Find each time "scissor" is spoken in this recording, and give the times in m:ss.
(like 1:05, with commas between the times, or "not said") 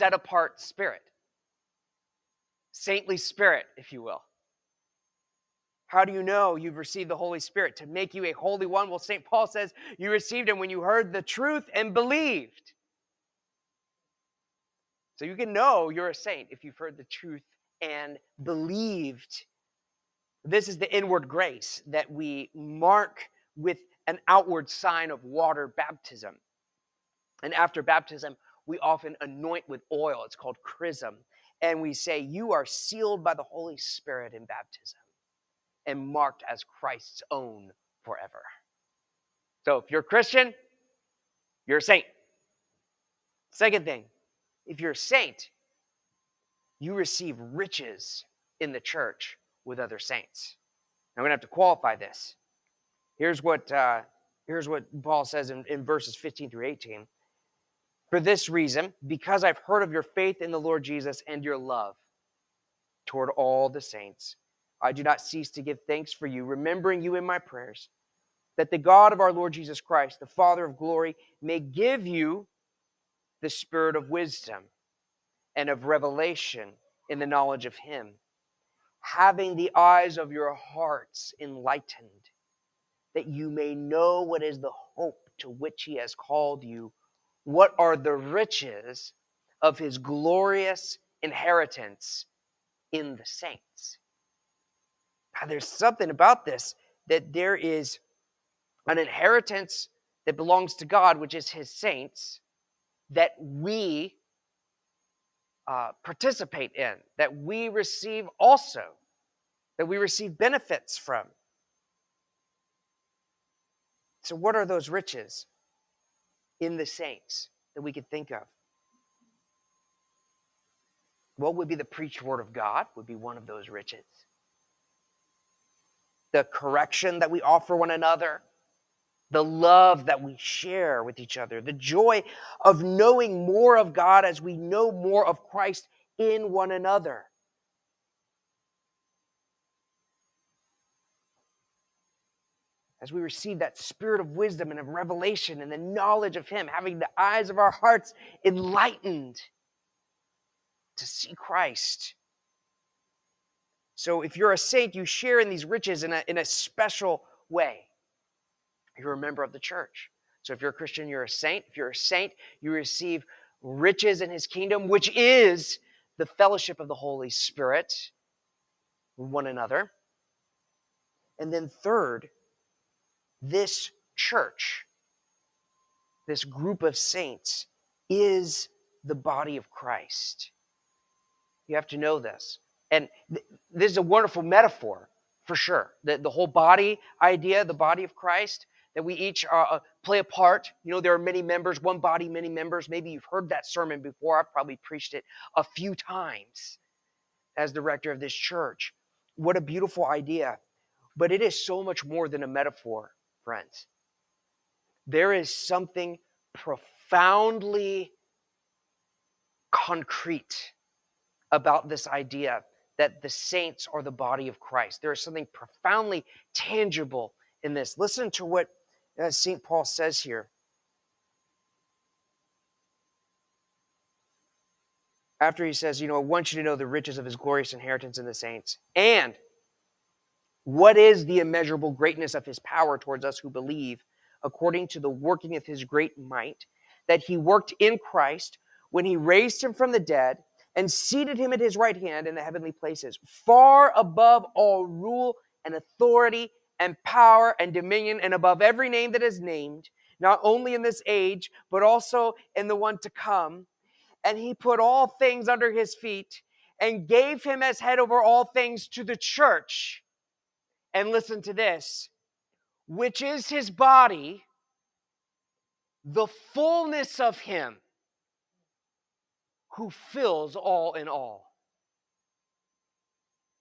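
not said.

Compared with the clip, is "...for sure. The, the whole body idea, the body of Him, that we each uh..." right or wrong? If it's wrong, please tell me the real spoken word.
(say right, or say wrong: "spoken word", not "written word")
wrong: "Christ", not "Him".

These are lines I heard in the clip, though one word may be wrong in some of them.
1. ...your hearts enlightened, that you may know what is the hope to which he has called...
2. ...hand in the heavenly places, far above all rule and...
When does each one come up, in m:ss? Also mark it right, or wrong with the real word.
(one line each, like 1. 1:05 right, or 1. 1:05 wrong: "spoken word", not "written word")
1. 1:20 right
2. 4:01 right.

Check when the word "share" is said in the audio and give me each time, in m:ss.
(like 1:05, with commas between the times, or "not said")
2:10, 2:35.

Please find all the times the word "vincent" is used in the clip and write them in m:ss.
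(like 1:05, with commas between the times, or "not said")
not said.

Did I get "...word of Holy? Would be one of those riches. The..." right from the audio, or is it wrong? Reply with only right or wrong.
wrong.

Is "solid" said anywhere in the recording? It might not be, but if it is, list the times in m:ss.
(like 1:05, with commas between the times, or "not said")
not said.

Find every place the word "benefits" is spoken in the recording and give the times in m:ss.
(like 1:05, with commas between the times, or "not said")
1:50.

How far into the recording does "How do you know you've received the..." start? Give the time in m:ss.
0:05.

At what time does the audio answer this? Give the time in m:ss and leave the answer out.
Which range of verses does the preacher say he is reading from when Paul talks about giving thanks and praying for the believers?
0:56.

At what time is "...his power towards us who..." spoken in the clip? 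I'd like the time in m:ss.
3:52.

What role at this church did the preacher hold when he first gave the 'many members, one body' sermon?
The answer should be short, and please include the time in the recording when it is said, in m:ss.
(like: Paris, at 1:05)
Director, at 3:17.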